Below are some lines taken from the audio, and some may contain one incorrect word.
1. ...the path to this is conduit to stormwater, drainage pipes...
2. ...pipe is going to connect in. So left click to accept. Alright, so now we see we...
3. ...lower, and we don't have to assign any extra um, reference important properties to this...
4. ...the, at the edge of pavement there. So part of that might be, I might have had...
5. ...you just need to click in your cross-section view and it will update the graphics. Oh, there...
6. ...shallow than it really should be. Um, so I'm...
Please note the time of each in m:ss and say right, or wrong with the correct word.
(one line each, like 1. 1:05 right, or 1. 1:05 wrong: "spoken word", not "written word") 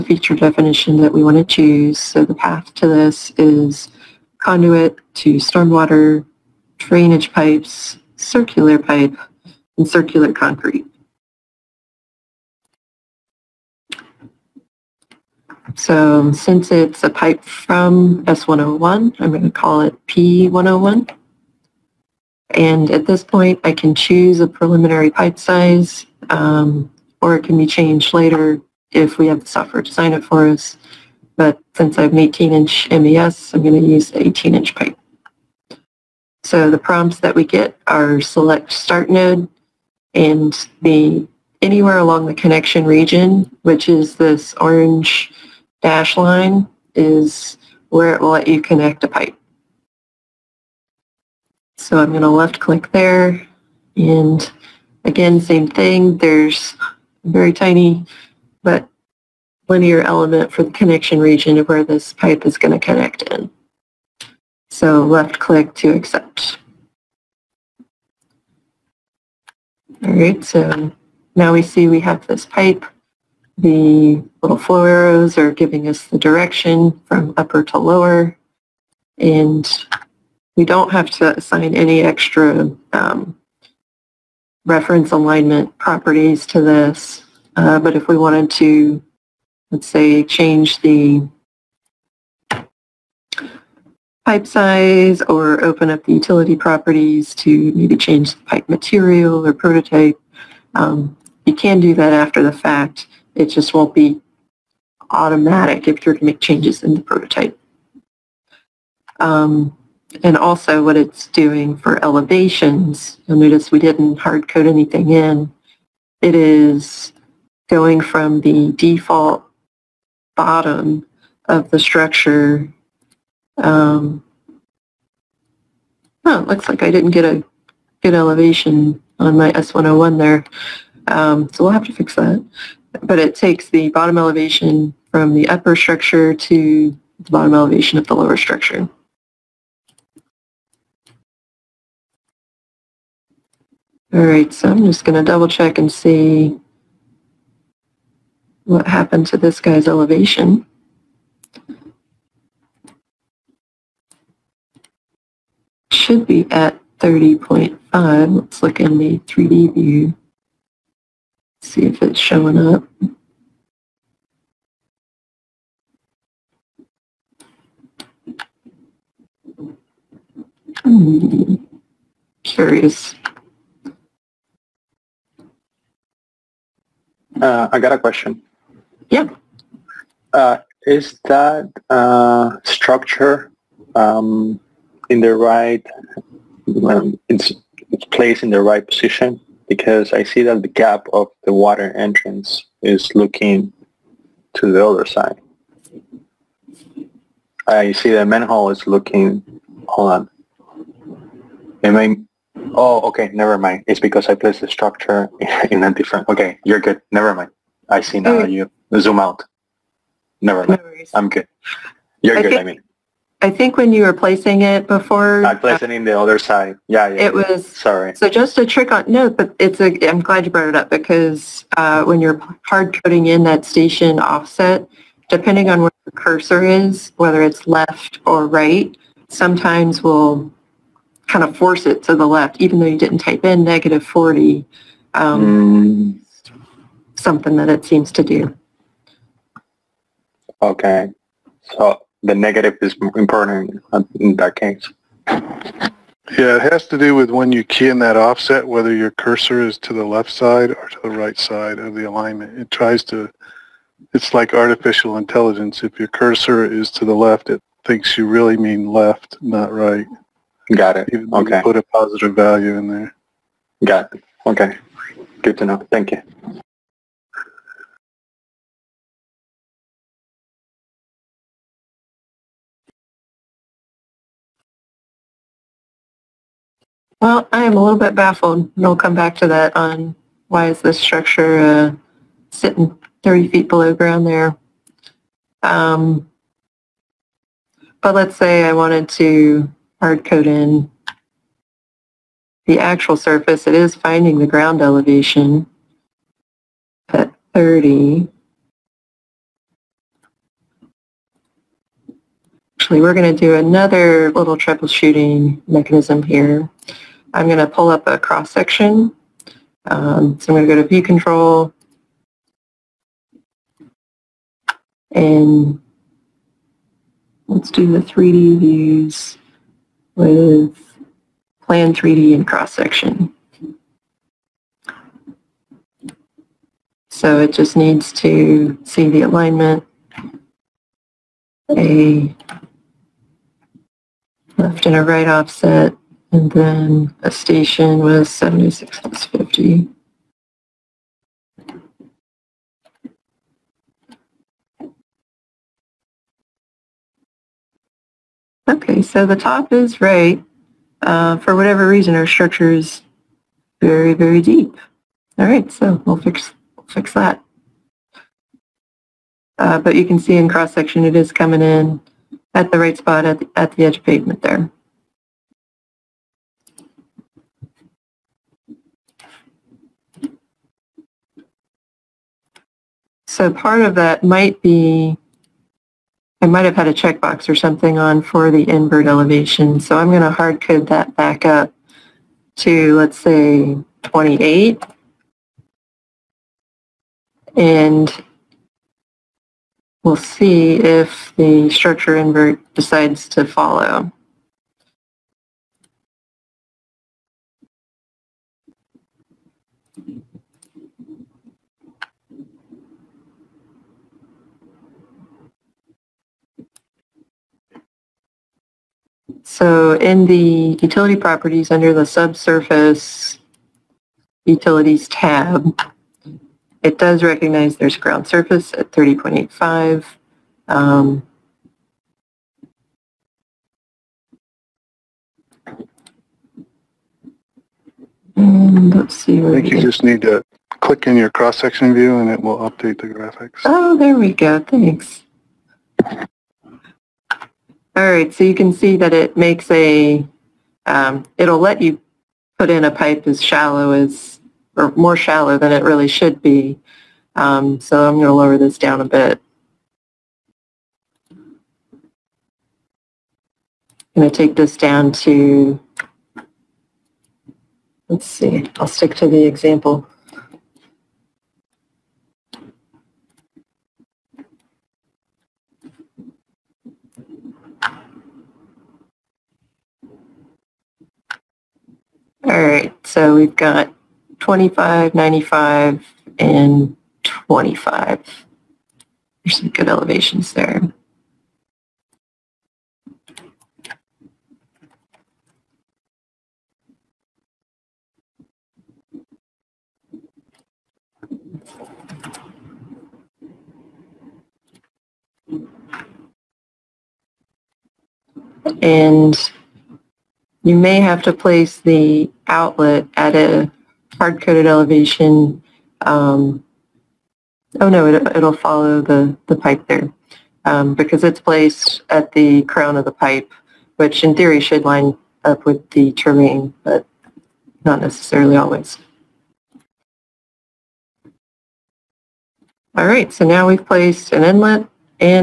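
1. 0:02 right
2. 1:02 right
3. 1:17 wrong: "alignment", not "important"
4. 6:03 right
5. 7:09 right
6. 7:25 right.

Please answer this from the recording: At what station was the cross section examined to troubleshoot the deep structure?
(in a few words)
76+50.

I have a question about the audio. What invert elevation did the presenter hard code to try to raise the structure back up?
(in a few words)
28.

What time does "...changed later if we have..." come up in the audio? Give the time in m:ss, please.
0:27.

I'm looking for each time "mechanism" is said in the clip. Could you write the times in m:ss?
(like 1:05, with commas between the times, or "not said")
5:05.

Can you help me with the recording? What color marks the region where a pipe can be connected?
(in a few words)
Orange.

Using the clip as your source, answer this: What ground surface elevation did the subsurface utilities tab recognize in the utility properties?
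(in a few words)
30.85.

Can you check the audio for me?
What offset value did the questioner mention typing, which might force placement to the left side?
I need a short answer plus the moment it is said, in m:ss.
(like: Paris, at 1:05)
Negative 40, at 3:53.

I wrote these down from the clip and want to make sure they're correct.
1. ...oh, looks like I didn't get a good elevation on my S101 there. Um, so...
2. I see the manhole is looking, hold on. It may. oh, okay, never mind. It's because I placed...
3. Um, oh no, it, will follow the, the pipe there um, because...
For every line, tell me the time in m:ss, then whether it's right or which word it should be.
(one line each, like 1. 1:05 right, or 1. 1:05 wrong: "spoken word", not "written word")
1. 2:06 right
2. 3:17 right
3. 8:26 right.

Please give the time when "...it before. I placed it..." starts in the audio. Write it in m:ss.
3:34.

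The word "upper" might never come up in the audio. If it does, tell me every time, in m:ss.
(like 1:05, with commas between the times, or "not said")
1:17, 2:15.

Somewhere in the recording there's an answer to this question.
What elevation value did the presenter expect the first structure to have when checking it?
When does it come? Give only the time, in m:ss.
2:36.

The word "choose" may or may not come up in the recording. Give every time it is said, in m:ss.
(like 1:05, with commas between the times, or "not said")
0:01, 0:23.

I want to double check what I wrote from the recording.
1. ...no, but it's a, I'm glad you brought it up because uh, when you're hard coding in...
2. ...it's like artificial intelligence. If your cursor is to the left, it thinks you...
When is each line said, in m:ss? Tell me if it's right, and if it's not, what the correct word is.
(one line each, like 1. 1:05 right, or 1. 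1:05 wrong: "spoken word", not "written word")
1. 3:39 right
2. 4:14 right.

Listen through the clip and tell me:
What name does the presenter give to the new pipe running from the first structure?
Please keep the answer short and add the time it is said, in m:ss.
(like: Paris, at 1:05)
P101, at 0:20.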